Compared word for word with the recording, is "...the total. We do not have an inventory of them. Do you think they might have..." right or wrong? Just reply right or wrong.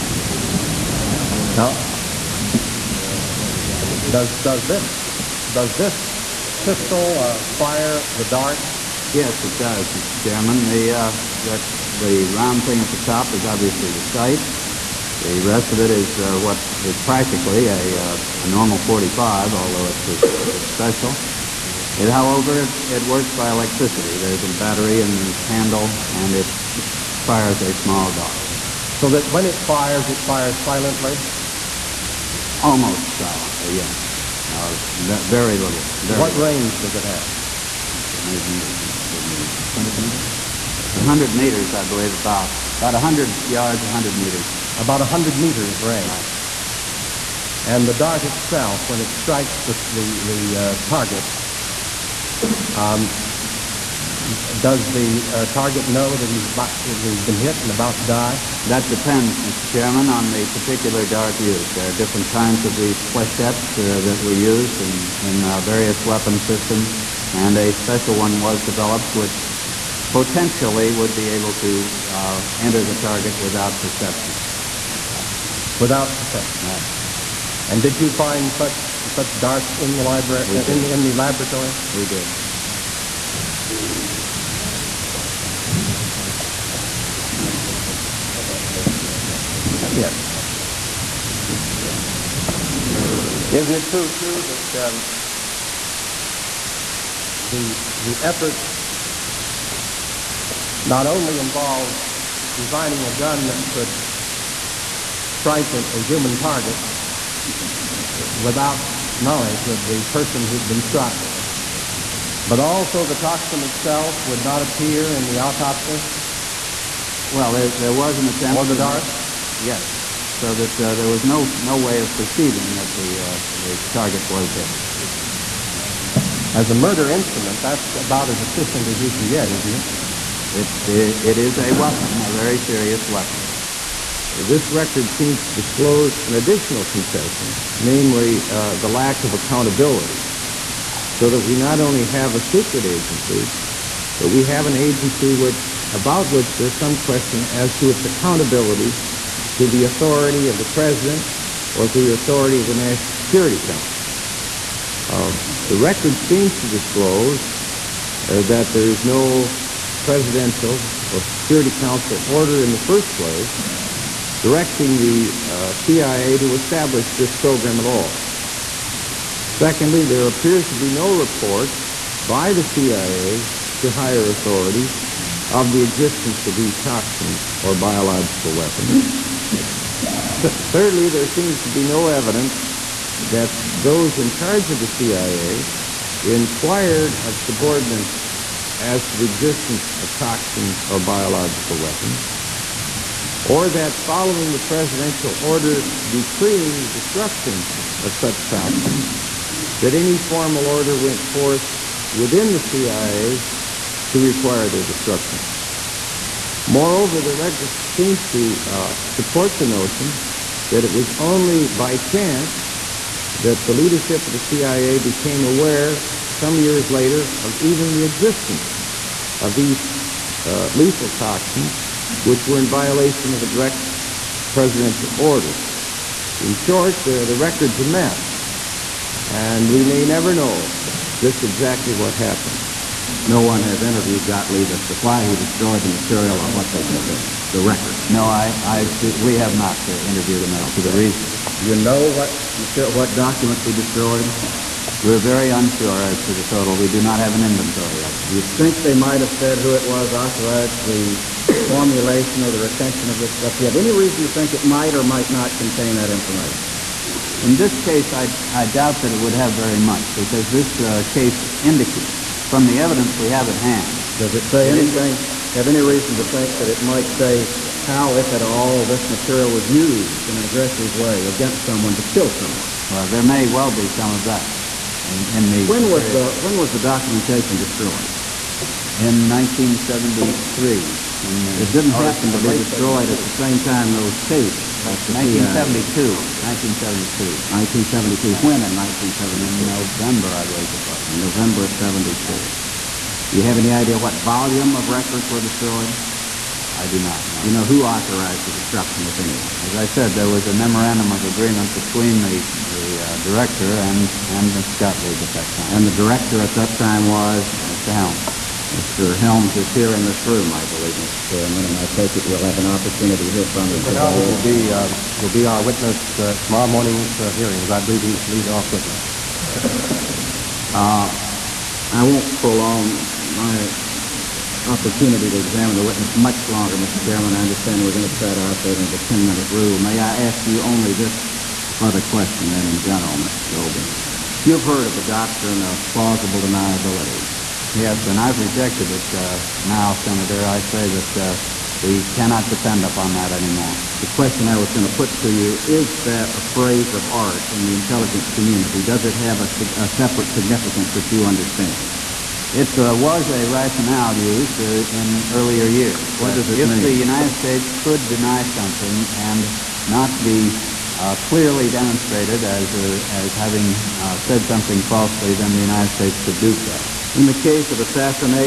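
right.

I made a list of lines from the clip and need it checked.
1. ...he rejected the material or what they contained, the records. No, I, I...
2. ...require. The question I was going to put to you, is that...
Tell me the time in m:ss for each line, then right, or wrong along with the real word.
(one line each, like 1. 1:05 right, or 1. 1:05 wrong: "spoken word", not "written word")
1. 3:55 wrong: "destroyed", not "rejected"
2. 5:43 wrong: "anymore", not "require".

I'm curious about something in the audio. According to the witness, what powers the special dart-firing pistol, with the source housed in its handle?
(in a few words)
A battery.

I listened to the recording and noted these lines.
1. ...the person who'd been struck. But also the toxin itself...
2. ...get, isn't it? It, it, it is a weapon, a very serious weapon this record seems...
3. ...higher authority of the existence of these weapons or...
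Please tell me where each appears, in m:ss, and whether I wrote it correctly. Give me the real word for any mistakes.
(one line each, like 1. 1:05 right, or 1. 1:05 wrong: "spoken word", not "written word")
1. 1:49 right
2. 2:09 right
3. 2:53 wrong: "toxins", not "weapons".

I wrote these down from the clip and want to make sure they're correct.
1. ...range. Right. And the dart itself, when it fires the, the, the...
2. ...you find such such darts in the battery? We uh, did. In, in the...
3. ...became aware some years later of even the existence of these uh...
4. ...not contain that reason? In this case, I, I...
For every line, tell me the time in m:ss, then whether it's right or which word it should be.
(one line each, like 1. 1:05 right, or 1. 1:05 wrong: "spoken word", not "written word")
1. 0:45 wrong: "strikes", not "fires"
2. 1:17 wrong: "library", not "battery"
3. 3:34 right
4. 4:15 wrong: "information", not "reason".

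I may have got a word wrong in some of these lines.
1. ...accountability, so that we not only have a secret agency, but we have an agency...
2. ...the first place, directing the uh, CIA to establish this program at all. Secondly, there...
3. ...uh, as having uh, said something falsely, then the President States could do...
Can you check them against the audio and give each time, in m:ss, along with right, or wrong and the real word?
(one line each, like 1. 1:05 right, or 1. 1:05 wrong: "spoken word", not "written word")
1. 2:19 right
2. 2:42 right
3. 6:02 wrong: "United", not "President".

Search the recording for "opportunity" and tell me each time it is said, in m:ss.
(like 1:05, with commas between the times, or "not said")
5:12, 5:24.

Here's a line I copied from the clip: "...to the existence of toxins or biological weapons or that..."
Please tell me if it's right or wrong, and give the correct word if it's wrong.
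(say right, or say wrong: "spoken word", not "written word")
right.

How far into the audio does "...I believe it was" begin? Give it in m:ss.
4:50.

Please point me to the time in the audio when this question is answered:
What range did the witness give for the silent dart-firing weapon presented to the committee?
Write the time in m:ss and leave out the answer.
0:42.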